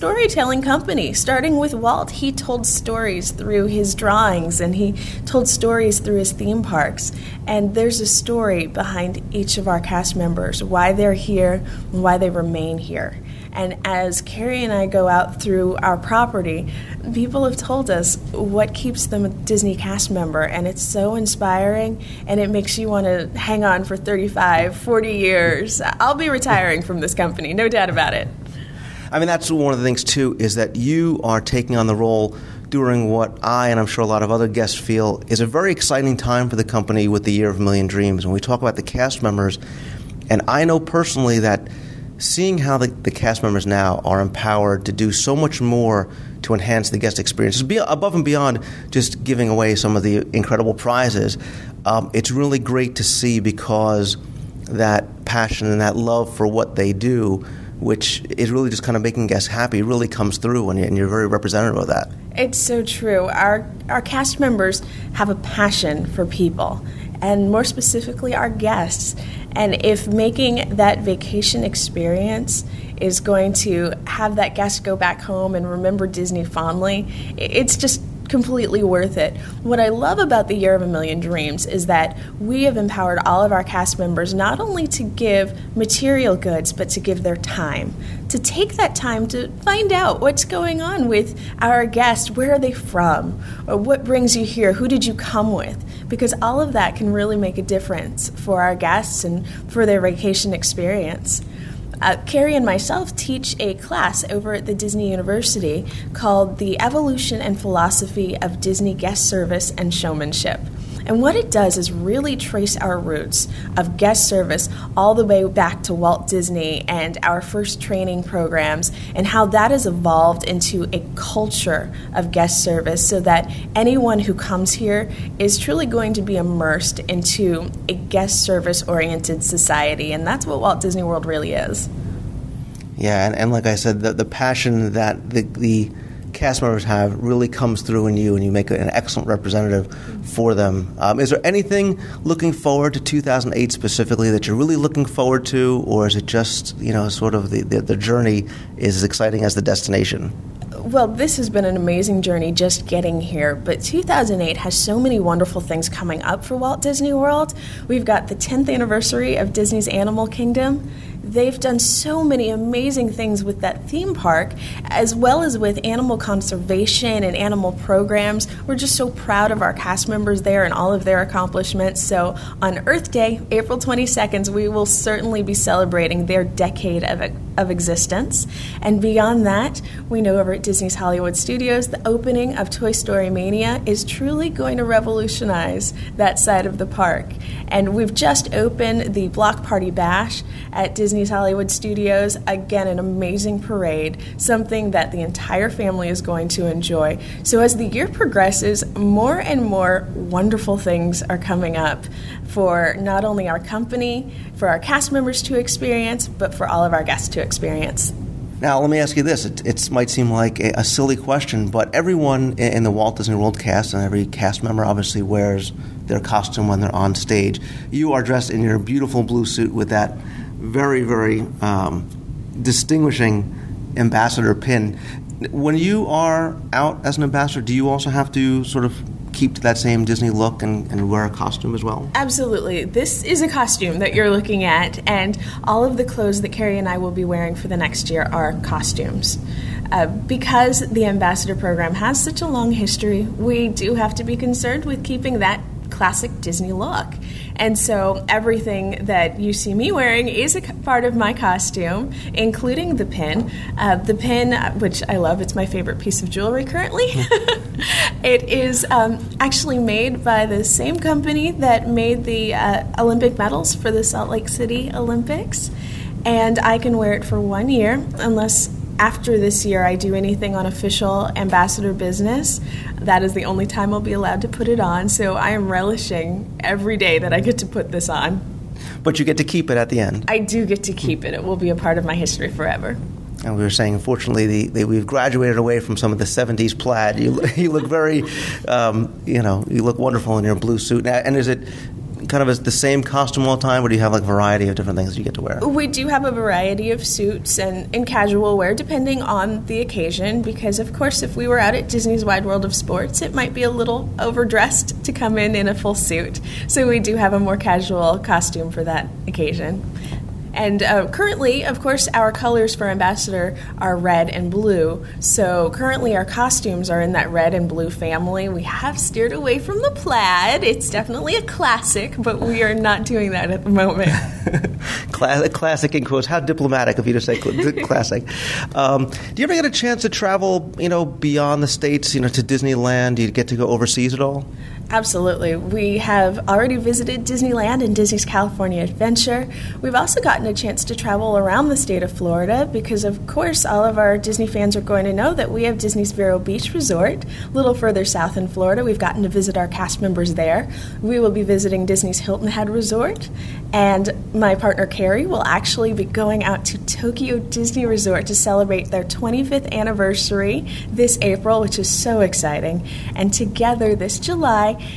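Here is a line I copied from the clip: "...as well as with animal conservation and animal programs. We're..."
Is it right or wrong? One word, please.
right.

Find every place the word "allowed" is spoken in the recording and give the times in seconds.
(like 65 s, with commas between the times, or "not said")
274 s.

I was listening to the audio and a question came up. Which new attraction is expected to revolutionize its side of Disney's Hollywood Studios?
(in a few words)
Toy Story Mania.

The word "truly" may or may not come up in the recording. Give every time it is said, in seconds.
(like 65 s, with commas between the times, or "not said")
125 s, 184 s.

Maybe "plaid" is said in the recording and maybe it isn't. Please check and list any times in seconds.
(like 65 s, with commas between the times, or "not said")
286 s, 319 s.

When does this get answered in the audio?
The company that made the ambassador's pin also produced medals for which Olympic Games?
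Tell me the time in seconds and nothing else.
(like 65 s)
264 s.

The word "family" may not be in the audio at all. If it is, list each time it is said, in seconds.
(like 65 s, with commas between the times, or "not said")
195 s, 317 s.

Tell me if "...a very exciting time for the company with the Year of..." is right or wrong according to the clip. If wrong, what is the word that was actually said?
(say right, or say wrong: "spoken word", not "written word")
right.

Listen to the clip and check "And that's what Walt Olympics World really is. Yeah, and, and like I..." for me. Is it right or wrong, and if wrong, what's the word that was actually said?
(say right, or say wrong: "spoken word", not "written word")
wrong: "Disney", not "Olympics".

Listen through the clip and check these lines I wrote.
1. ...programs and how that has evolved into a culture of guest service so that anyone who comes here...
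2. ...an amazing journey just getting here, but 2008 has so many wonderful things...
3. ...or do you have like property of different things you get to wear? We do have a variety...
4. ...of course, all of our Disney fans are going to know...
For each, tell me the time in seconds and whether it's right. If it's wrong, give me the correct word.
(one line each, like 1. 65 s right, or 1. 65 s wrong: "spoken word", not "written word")
1. 118 s right
2. 151 s right
3. 293 s wrong: "variety", not "property"
4. 343 s right.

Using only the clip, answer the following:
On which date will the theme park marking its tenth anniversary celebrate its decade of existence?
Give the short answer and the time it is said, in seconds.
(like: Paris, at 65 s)
April 22nd, at 173 s.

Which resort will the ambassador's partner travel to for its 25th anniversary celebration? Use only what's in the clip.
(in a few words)
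Tokyo Disney Resort.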